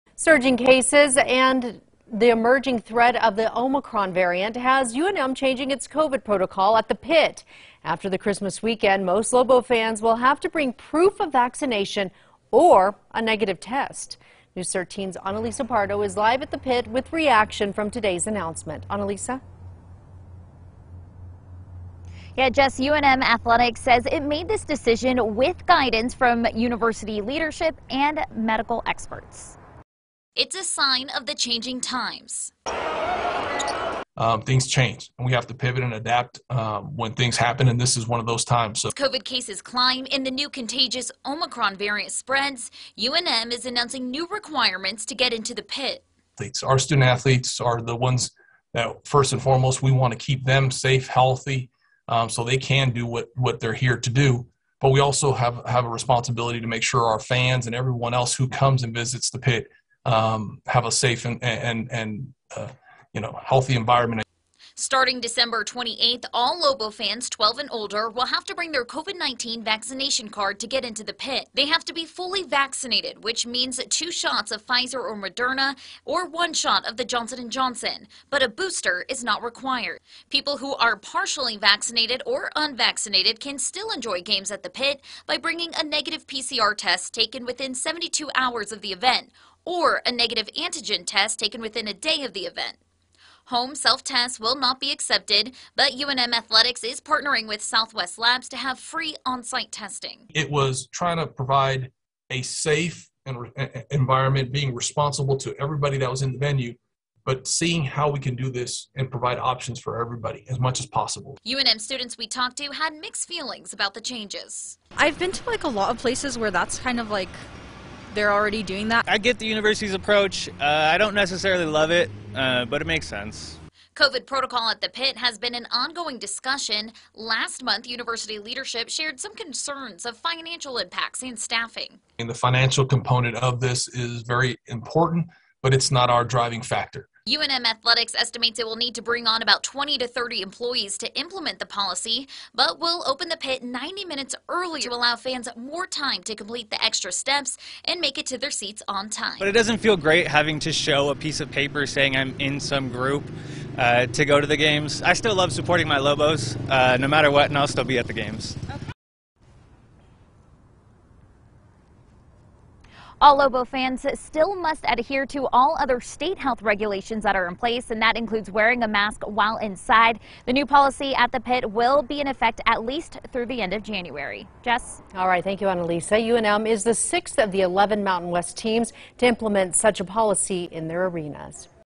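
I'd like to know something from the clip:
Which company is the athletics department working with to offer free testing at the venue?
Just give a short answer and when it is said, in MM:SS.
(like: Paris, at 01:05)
Southwest Labs, at 01:37.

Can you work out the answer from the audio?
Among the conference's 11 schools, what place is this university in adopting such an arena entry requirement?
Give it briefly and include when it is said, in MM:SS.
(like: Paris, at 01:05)
sixth, at 02:56.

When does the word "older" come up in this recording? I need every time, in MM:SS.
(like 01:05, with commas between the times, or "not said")
01:07.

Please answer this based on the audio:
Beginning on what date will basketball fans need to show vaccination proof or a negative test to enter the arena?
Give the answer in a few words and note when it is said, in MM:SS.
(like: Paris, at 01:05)
December 28, at 01:05.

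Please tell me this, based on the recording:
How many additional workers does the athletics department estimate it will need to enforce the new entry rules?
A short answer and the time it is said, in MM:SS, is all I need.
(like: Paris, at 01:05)
20 to 30, at 02:19.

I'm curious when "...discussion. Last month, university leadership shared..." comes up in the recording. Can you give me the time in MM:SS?
02:06.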